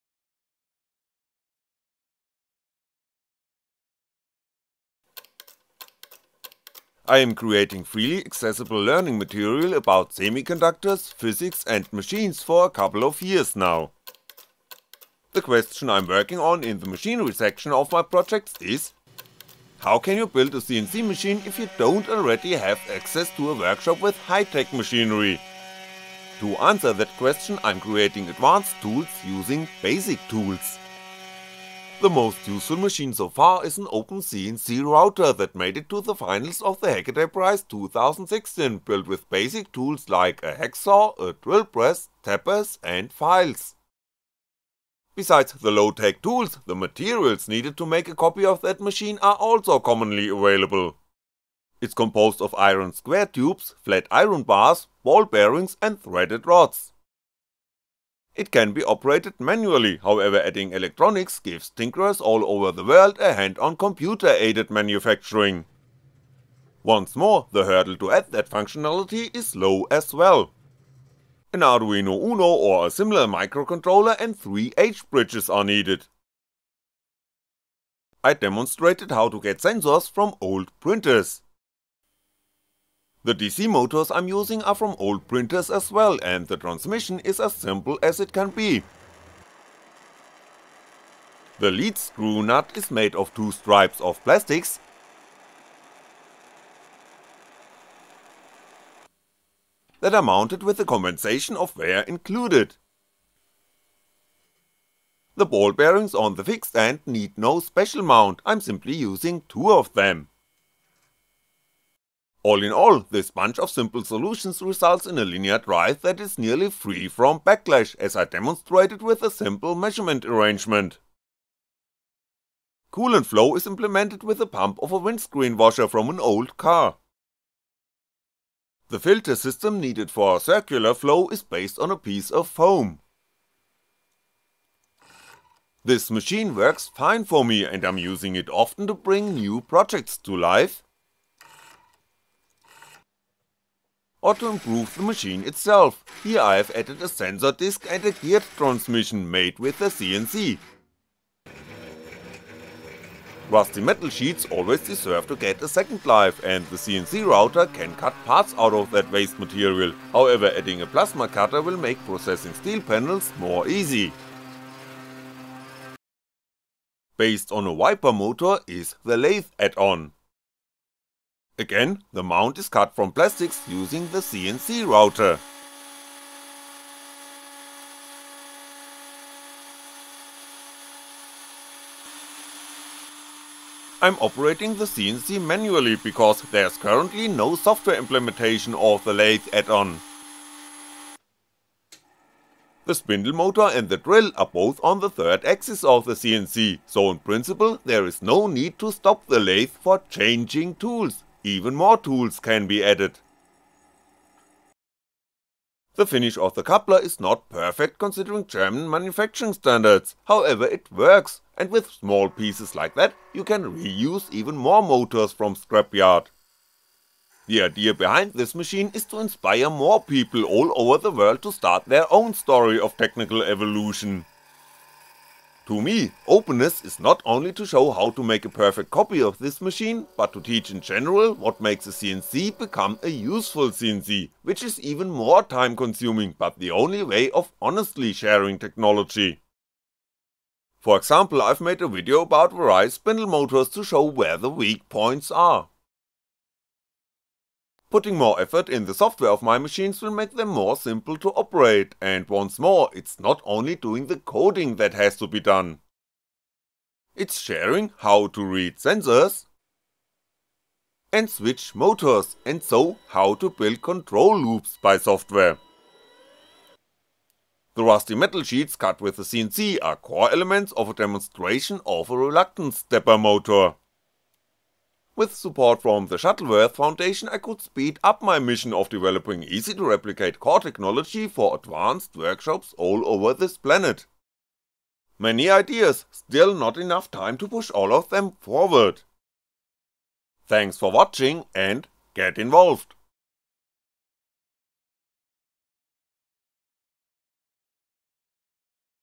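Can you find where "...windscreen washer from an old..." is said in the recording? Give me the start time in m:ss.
2:04.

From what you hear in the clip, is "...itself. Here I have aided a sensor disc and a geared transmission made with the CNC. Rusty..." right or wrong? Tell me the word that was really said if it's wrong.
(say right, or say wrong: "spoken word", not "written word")
wrong: "added", not "aided".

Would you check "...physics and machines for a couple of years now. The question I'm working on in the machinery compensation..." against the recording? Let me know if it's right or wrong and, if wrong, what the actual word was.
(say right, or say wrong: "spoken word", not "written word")
wrong: "section", not "compensation".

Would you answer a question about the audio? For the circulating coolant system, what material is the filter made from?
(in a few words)
foam.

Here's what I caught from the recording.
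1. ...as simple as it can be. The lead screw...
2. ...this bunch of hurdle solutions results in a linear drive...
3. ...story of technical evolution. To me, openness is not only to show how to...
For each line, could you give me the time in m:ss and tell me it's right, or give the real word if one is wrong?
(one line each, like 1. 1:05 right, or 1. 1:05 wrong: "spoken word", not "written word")
1. 1:27 right
2. 1:53 wrong: "simple", not "hurdle"
3. 3:42 right.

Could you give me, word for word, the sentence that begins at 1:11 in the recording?
An Arduino Uno or a similar microcontroller and 3 H-bridges are needed.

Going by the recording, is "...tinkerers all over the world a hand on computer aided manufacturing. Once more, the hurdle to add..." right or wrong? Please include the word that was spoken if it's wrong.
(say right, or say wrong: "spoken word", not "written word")
right.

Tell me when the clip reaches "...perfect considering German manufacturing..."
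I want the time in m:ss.
3:27.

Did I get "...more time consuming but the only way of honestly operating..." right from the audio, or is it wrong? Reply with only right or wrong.
wrong.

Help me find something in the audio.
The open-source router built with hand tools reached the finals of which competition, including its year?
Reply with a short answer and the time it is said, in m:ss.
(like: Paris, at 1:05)
Hackaday Prize 2016, at 0:36.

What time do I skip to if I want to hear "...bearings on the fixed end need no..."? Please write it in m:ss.
1:45.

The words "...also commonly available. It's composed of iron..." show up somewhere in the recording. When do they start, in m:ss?
0:49.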